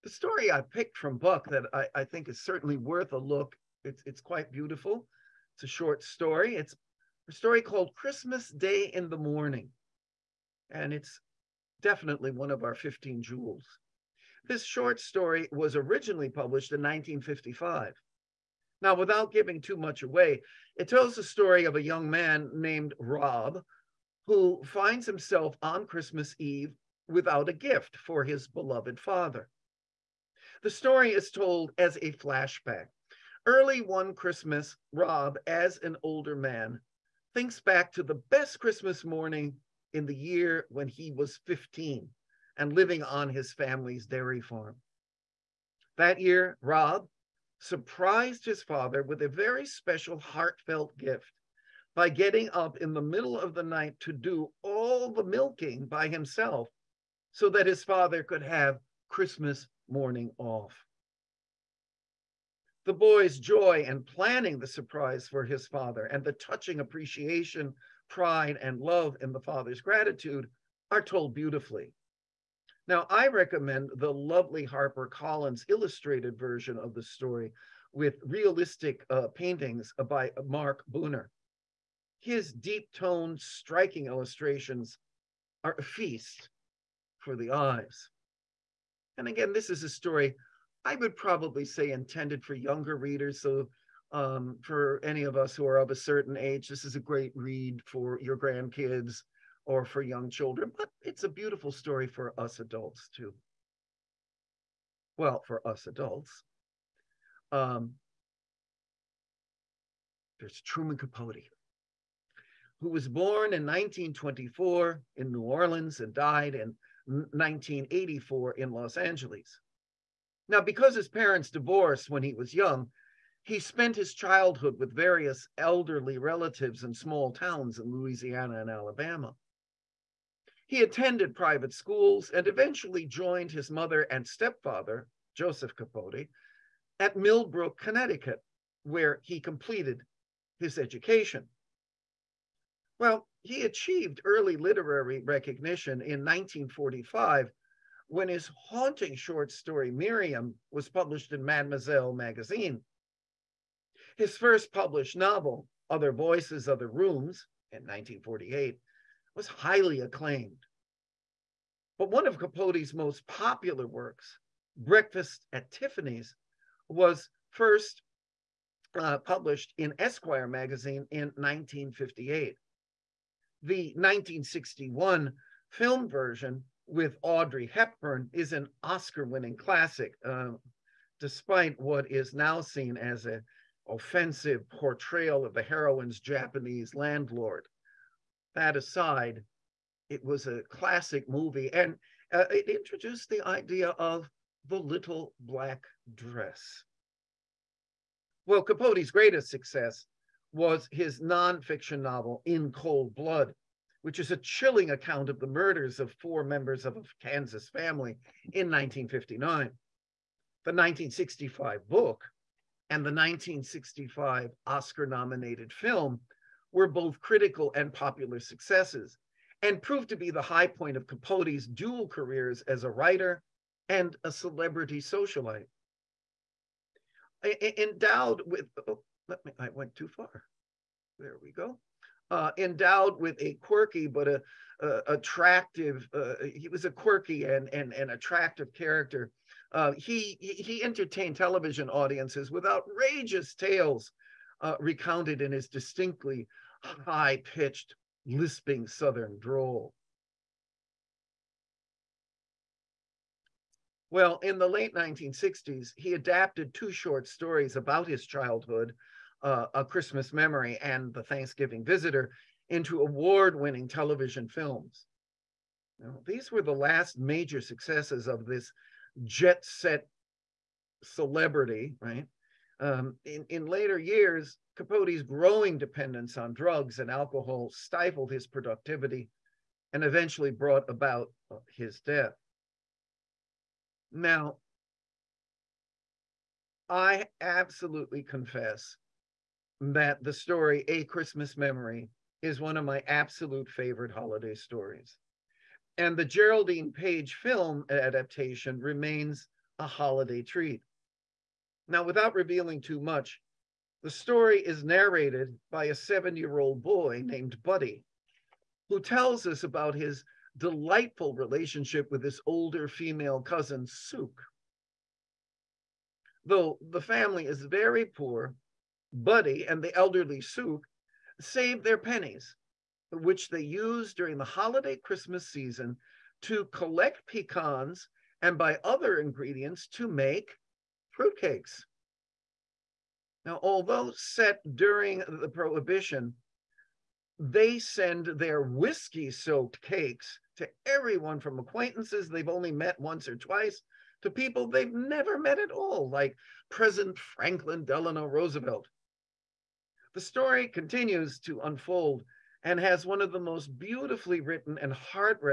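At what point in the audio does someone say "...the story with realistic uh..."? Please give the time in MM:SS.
01:16.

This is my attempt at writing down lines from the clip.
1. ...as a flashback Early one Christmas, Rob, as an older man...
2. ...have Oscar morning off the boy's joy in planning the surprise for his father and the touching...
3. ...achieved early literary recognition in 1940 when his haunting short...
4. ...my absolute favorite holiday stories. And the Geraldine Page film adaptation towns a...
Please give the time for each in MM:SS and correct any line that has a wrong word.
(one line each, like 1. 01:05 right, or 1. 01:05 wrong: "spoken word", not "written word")
1. 00:31 right
2. 00:58 wrong: "Christmas", not "Oscar"
3. 02:23 wrong: "1945", not "1940"
4. 04:52 wrong: "remains", not "towns".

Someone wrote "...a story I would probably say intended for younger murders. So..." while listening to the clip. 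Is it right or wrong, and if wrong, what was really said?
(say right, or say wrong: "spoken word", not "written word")
wrong: "readers", not "murders".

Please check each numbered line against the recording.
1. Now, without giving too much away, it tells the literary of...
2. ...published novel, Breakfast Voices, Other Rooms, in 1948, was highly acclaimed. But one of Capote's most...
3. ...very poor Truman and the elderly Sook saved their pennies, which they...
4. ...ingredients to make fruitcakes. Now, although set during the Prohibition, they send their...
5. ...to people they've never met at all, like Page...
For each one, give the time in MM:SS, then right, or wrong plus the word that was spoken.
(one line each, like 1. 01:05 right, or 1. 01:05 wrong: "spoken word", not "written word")
1. 00:18 wrong: "story", not "literary"
2. 02:34 wrong: "Other", not "Breakfast"
3. 05:17 wrong: "Buddy", not "Truman"
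4. 05:29 right
5. 05:44 wrong: "President", not "Page".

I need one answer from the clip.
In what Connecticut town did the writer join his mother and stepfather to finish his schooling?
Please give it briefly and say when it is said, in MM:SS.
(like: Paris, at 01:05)
Millbrook, at 02:17.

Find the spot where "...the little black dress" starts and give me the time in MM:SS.
03:14.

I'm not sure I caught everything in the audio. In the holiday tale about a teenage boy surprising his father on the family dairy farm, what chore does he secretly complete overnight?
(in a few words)
the milking.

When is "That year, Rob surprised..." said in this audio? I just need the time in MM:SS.
00:45.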